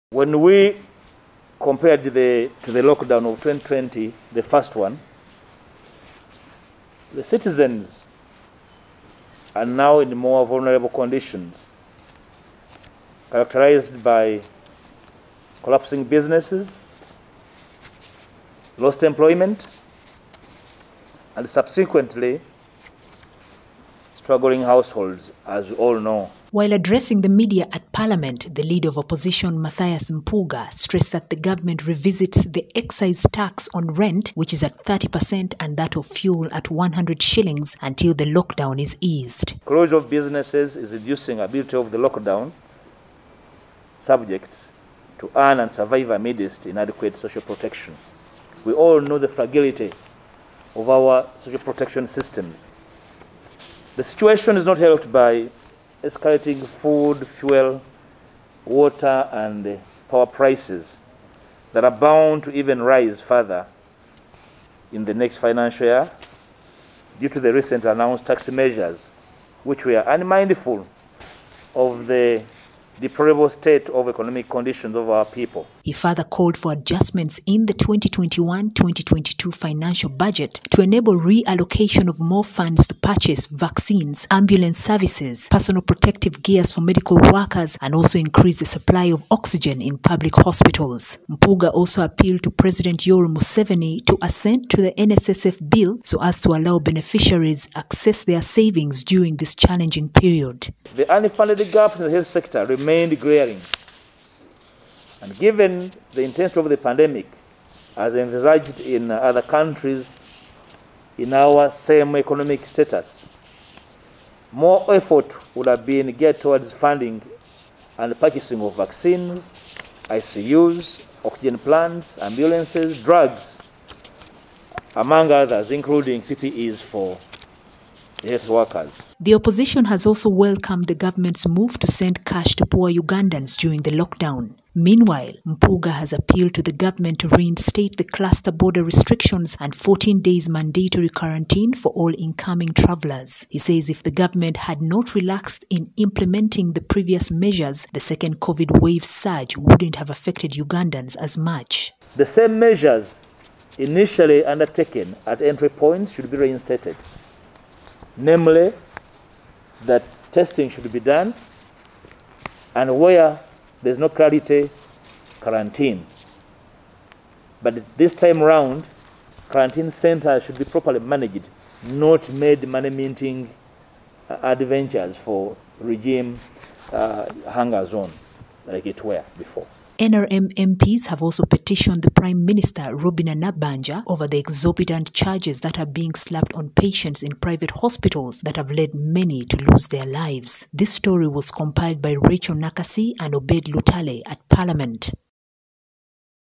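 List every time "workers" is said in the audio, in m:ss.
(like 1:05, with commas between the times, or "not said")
1:27, 2:08.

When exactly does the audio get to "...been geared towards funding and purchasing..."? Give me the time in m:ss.
1:55.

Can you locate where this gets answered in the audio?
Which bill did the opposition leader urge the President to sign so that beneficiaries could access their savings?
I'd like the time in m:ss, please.
1:34.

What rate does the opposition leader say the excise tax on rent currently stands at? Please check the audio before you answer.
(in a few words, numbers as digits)
30%.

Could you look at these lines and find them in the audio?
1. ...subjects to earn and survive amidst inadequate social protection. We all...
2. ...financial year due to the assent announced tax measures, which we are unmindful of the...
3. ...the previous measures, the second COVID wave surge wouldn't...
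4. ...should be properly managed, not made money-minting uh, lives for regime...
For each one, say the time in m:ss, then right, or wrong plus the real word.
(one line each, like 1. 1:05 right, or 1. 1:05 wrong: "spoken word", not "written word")
1. 0:43 right
2. 1:05 wrong: "recent", not "assent"
3. 2:26 right
4. 2:50 wrong: "adventures", not "lives".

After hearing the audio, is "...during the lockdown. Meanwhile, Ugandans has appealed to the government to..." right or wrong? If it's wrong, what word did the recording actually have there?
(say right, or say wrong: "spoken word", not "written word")
wrong: "Mpuuga", not "Ugandans".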